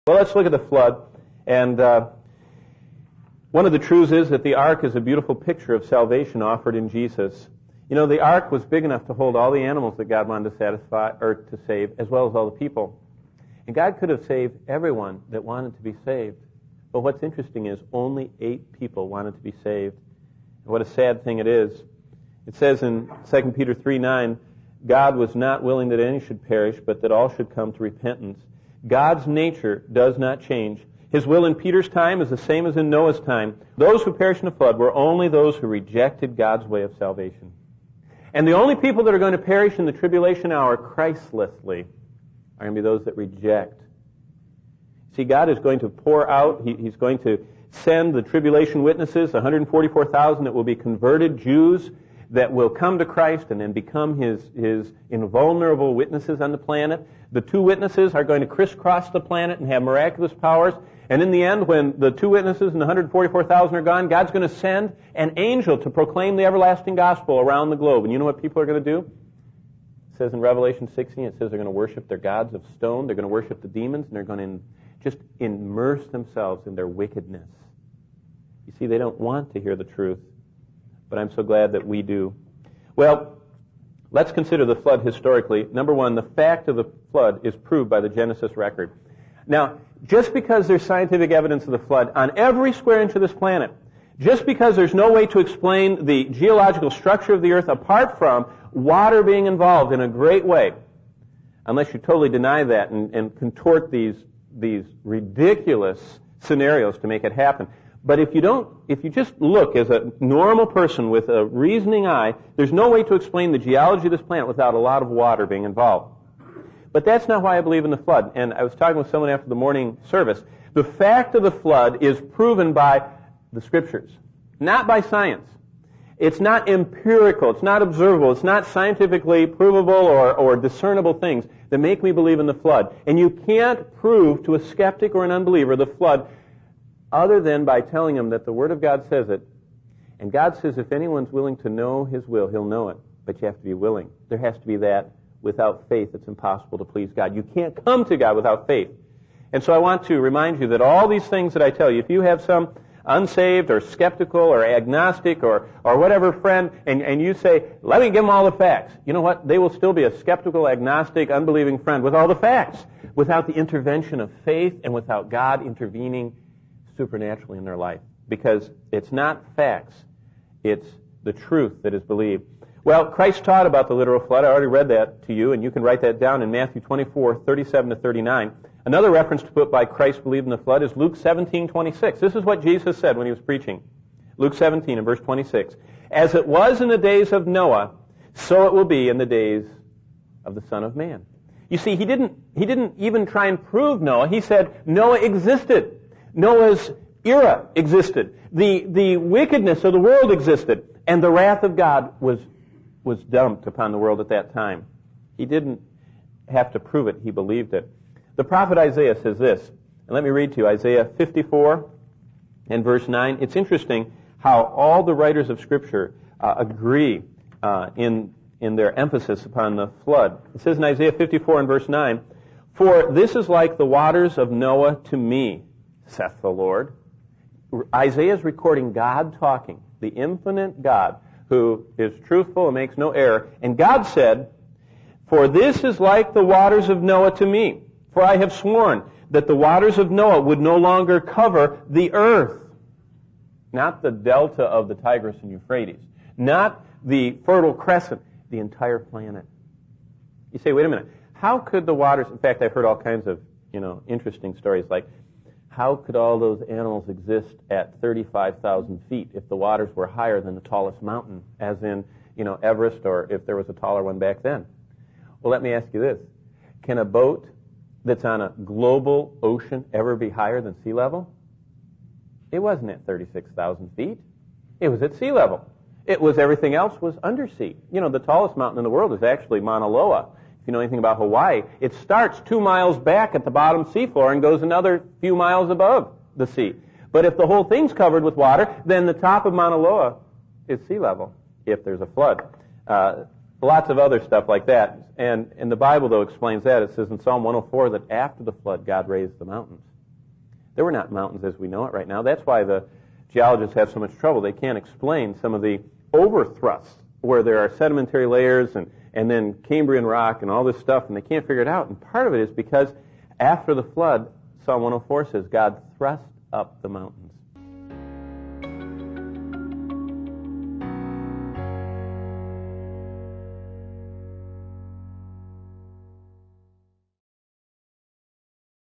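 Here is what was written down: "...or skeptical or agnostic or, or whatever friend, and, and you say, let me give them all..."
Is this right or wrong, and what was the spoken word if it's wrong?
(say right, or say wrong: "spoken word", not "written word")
right.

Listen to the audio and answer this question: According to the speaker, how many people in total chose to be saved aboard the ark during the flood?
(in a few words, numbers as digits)
8.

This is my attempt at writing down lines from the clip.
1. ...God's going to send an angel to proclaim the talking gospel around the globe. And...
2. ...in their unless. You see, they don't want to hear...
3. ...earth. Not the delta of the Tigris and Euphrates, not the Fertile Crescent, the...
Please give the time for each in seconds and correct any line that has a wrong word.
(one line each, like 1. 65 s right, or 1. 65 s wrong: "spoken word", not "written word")
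1. 64 s wrong: "everlasting", not "talking"
2. 76 s wrong: "wickedness", not "unless"
3. 242 s right.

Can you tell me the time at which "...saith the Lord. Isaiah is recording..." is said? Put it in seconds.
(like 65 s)
226 s.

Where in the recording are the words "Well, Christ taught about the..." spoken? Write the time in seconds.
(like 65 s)
172 s.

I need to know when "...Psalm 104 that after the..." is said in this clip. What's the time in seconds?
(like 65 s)
297 s.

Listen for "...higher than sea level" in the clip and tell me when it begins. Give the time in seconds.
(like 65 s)
270 s.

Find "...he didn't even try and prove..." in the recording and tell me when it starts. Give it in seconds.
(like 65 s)
192 s.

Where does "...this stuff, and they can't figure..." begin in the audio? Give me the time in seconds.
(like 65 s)
310 s.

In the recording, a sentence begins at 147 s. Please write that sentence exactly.
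You can't come to God without faith.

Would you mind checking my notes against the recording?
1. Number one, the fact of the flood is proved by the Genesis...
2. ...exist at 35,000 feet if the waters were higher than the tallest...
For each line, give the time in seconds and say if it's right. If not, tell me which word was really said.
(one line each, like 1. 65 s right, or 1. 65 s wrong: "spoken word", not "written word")
1. 85 s right
2. 257 s right.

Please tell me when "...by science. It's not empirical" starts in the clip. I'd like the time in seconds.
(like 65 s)
124 s.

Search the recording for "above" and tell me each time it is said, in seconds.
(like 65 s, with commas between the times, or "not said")
285 s.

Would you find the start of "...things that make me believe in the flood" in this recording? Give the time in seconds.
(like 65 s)
131 s.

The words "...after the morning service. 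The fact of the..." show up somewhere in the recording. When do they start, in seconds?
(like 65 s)
119 s.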